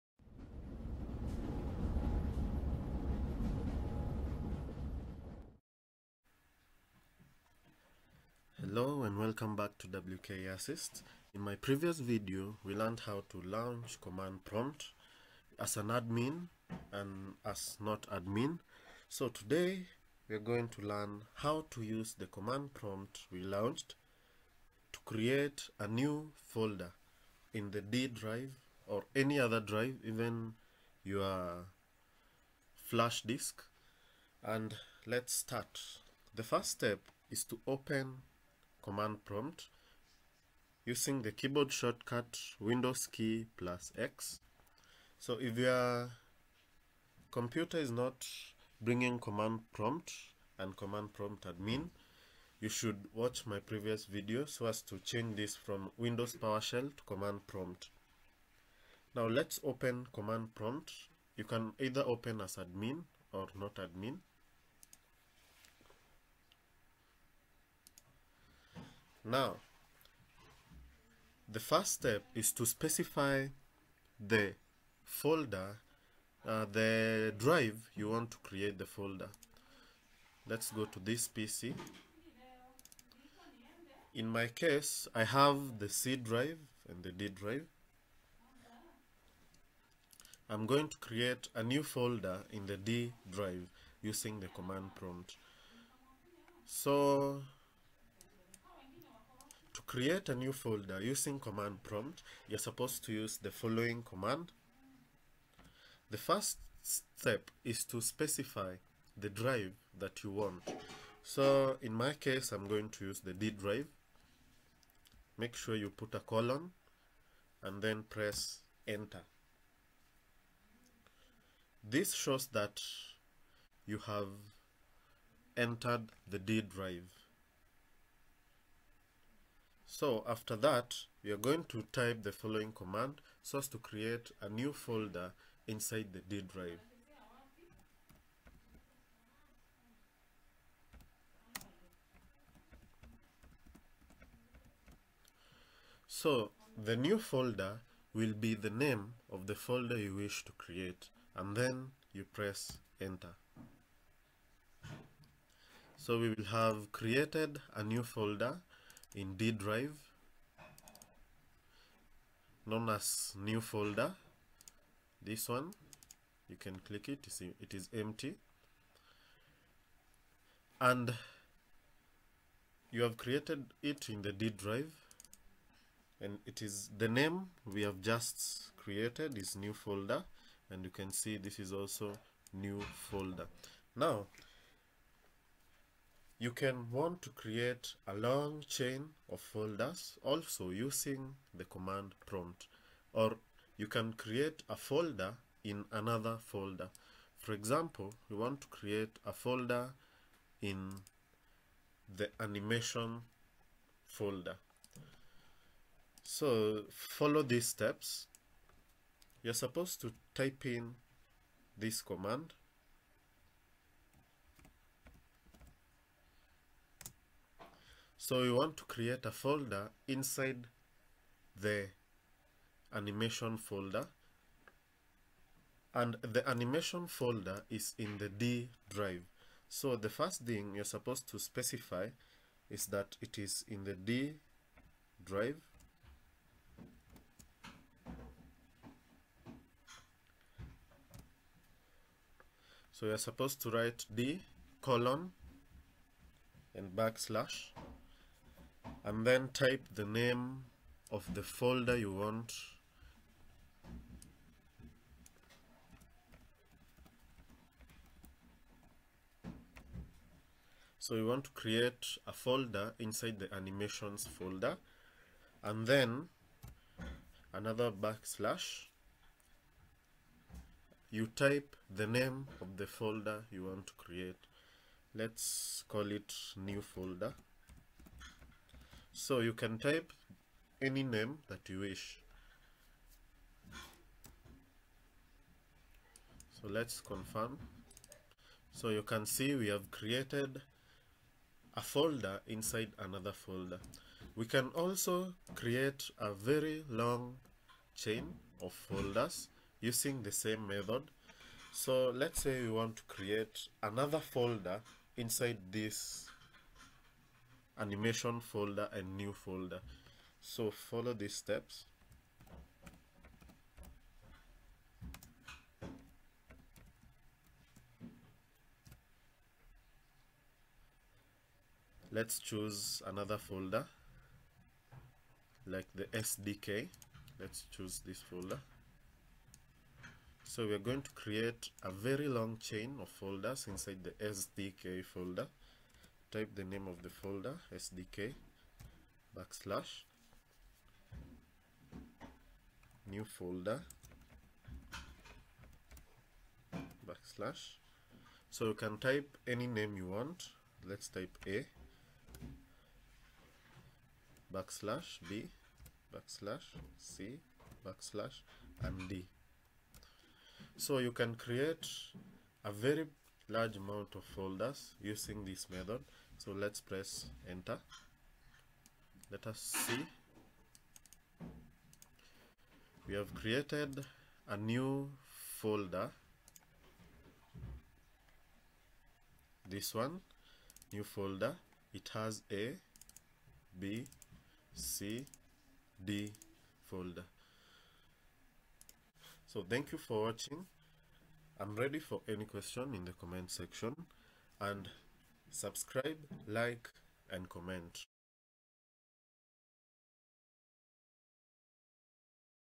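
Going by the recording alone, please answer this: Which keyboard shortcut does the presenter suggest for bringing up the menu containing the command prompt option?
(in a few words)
Windows key plus X.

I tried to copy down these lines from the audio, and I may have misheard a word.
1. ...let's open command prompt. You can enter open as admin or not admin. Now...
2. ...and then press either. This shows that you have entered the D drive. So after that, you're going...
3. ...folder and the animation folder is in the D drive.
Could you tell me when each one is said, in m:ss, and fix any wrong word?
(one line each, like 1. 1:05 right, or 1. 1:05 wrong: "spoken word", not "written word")
1. 0:59 wrong: "either", not "enter"
2. 1:57 wrong: "enter", not "either"
3. 3:43 right.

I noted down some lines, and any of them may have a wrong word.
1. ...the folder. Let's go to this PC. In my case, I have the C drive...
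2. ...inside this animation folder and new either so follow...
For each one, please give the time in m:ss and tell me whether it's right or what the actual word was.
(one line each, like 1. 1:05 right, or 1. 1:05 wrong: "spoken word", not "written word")
1. 1:18 right
2. 5:05 wrong: "folder", not "either".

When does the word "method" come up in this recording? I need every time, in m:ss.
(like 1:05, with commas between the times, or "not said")
5:00, 6:05.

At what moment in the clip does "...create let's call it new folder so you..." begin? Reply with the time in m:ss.
4:33.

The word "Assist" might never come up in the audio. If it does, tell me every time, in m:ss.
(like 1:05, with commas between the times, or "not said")
0:10.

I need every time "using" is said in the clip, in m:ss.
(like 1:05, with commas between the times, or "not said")
0:40, 1:34, 1:41, 3:10, 4:59, 6:05.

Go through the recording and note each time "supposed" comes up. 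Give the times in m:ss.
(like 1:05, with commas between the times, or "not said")
1:42, 3:29, 3:50, 4:03.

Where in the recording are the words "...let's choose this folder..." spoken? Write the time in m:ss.
5:27.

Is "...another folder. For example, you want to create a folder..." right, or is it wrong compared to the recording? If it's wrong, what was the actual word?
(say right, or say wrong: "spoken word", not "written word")
right.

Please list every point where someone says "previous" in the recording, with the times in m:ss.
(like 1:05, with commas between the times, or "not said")
0:11, 0:53.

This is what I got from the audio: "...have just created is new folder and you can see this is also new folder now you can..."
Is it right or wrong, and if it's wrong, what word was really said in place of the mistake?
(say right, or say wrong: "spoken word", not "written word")
right.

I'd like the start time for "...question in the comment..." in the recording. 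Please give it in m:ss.
6:32.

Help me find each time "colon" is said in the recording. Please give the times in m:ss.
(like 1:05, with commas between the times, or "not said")
1:56, 4:04.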